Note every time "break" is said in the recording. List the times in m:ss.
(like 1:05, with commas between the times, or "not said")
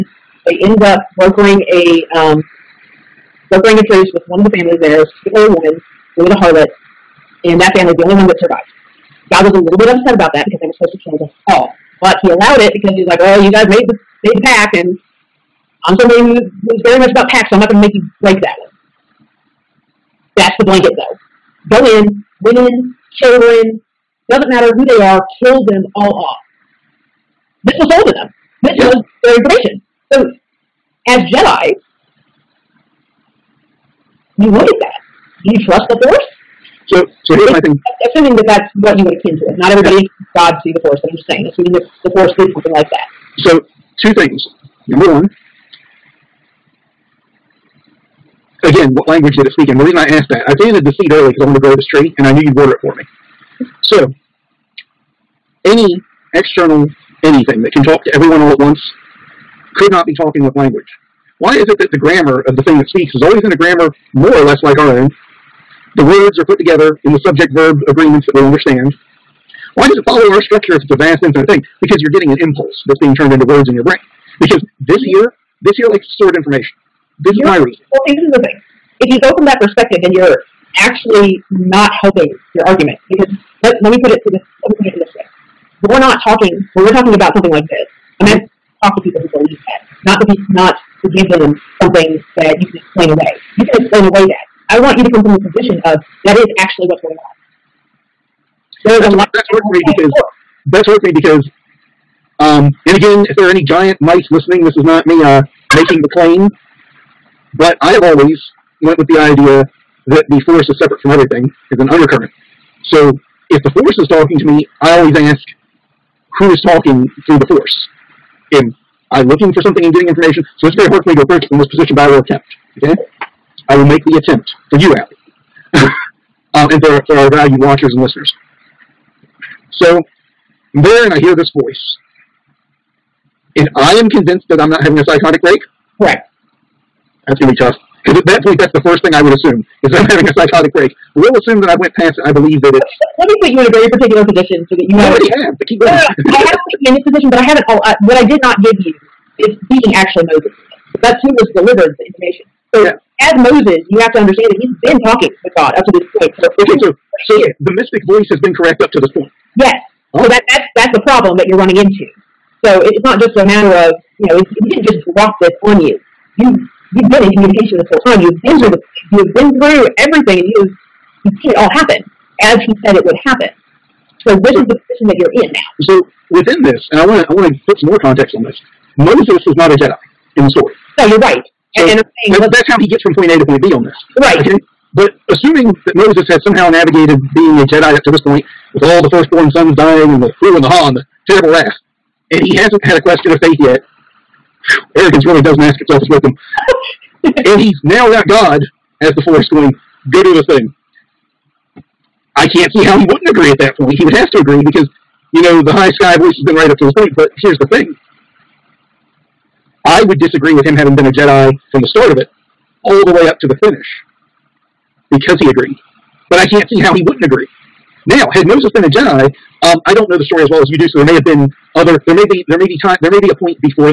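0:18, 2:15, 2:20.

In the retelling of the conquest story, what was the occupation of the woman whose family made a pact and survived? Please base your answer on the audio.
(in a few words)
harlot.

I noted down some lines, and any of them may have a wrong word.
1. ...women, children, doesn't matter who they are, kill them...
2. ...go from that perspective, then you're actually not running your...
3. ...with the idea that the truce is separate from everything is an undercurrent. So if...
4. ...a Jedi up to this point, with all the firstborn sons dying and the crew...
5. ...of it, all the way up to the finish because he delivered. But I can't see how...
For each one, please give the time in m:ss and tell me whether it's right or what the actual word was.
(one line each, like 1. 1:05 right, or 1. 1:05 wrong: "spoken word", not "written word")
1. 0:22 right
2. 1:19 wrong: "helping", not "running"
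3. 1:48 wrong: "force", not "truce"
4. 3:07 right
5. 3:32 wrong: "agreed", not "delivered".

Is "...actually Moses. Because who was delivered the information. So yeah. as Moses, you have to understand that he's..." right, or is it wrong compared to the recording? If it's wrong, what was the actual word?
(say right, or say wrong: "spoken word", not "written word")
right.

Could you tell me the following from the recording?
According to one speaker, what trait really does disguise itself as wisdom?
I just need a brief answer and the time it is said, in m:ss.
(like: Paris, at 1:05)
Arrogance, at 3:14.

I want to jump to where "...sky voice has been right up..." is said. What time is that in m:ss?
3:25.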